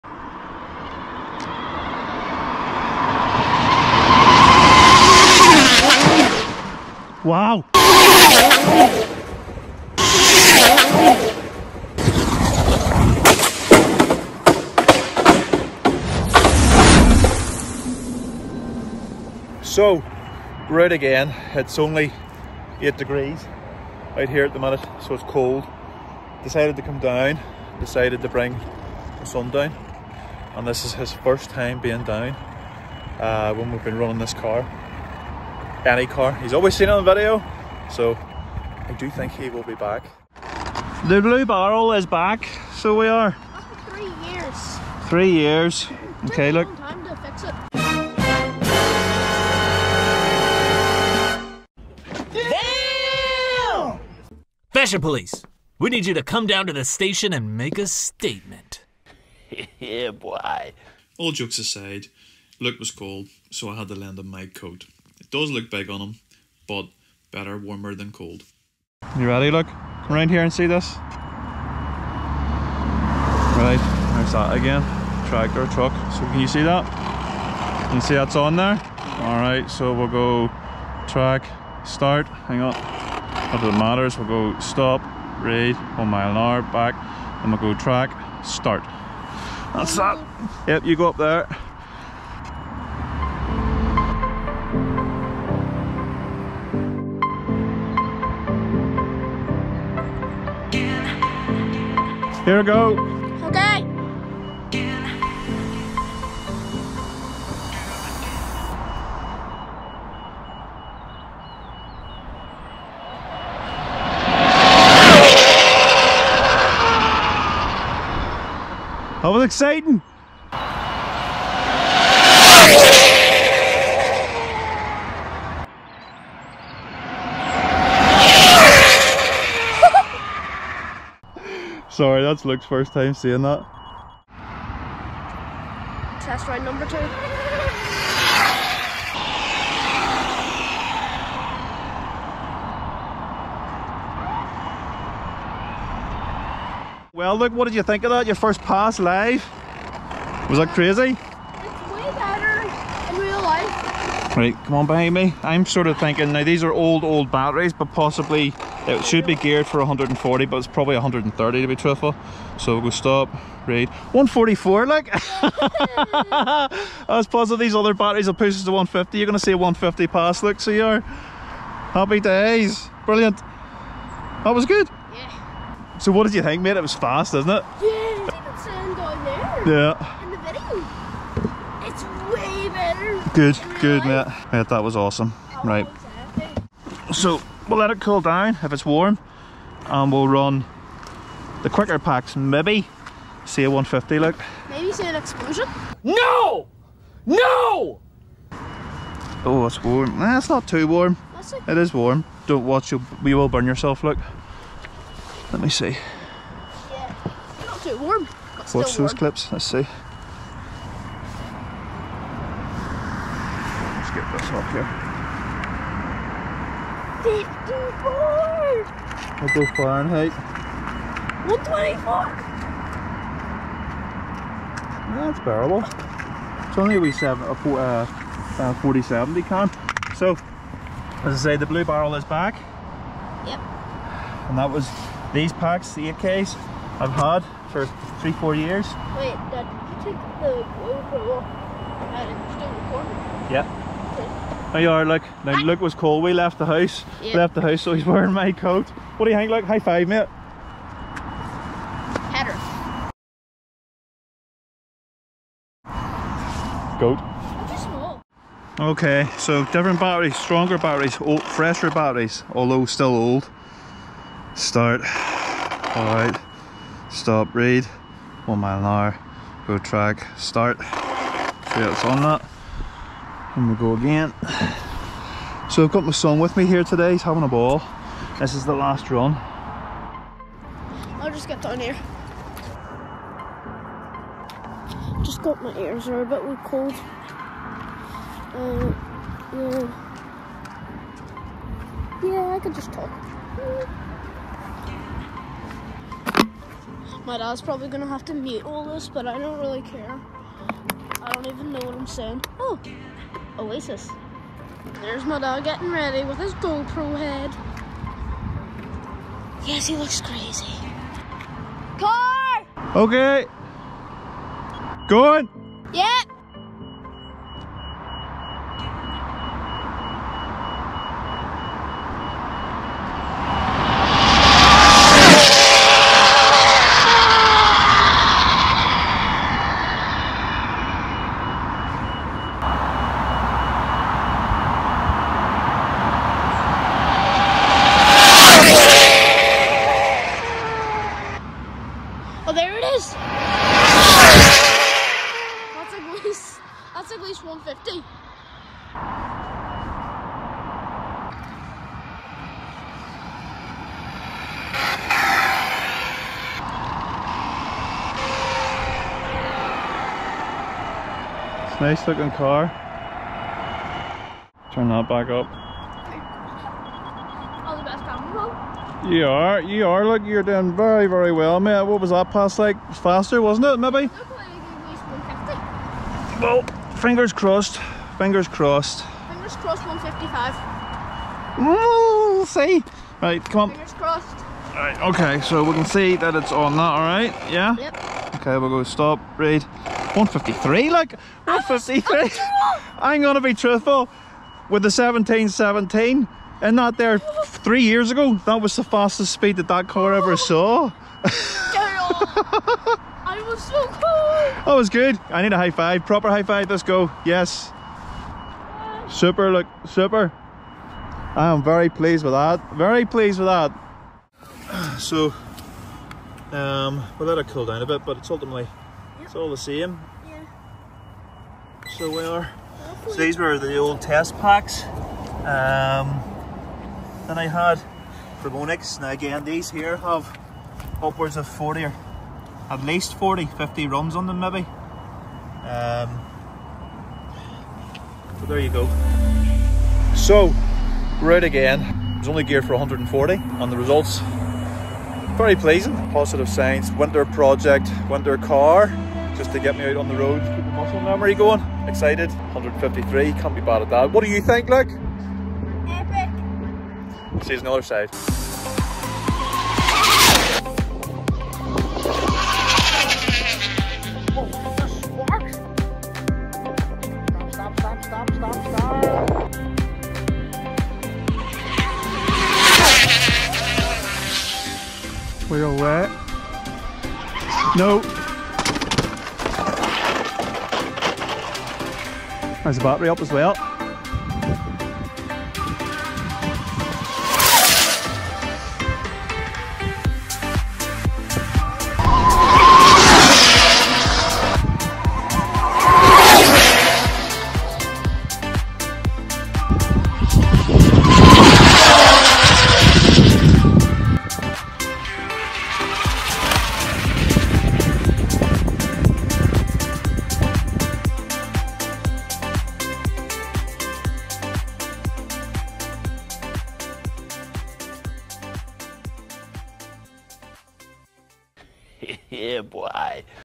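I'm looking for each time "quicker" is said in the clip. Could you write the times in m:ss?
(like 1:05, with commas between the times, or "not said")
3:11.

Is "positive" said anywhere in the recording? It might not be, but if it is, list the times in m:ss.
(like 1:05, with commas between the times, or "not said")
2:47, 7:26.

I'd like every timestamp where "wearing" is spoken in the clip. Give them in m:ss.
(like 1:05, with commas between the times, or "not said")
4:08.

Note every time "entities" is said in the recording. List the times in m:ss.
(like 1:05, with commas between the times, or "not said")
not said.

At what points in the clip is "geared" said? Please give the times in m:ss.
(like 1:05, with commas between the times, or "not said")
2:39, 7:22.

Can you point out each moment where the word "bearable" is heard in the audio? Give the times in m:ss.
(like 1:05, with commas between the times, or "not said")
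3:45.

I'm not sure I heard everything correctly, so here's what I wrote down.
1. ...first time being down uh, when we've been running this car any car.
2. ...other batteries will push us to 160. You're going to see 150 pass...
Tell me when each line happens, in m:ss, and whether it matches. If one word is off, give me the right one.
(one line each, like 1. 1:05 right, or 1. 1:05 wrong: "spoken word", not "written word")
1. 0:31 right
2. 2:47 wrong: "150", not "160".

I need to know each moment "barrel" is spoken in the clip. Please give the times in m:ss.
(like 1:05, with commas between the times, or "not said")
0:41, 3:51, 4:01.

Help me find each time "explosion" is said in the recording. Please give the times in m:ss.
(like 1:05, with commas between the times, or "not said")
3:15.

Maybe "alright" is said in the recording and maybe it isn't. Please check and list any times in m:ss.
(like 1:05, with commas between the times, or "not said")
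1:19, 4:25, 6:26.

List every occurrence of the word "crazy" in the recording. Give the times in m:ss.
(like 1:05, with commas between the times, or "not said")
2:30, 5:10.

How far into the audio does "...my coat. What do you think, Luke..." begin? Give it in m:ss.
4:08.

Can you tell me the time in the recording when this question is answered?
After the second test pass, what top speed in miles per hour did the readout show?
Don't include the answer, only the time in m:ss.
2:44.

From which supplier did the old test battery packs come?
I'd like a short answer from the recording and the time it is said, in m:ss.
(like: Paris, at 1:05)
Onyx, at 7:08.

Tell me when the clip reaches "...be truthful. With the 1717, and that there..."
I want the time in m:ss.
6:33.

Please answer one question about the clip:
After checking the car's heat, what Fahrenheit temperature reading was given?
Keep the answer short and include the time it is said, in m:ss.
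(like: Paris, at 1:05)
124, at 3:41.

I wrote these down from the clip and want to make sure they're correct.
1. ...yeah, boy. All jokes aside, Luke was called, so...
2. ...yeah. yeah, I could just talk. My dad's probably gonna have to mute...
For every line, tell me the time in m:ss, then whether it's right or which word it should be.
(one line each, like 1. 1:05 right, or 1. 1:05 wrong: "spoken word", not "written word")
1. 0:59 right
2. 4:49 right.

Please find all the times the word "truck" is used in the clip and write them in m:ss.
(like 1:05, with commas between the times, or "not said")
1:15.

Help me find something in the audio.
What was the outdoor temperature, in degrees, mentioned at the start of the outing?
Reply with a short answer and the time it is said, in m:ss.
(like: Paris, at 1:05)
8, at 0:22.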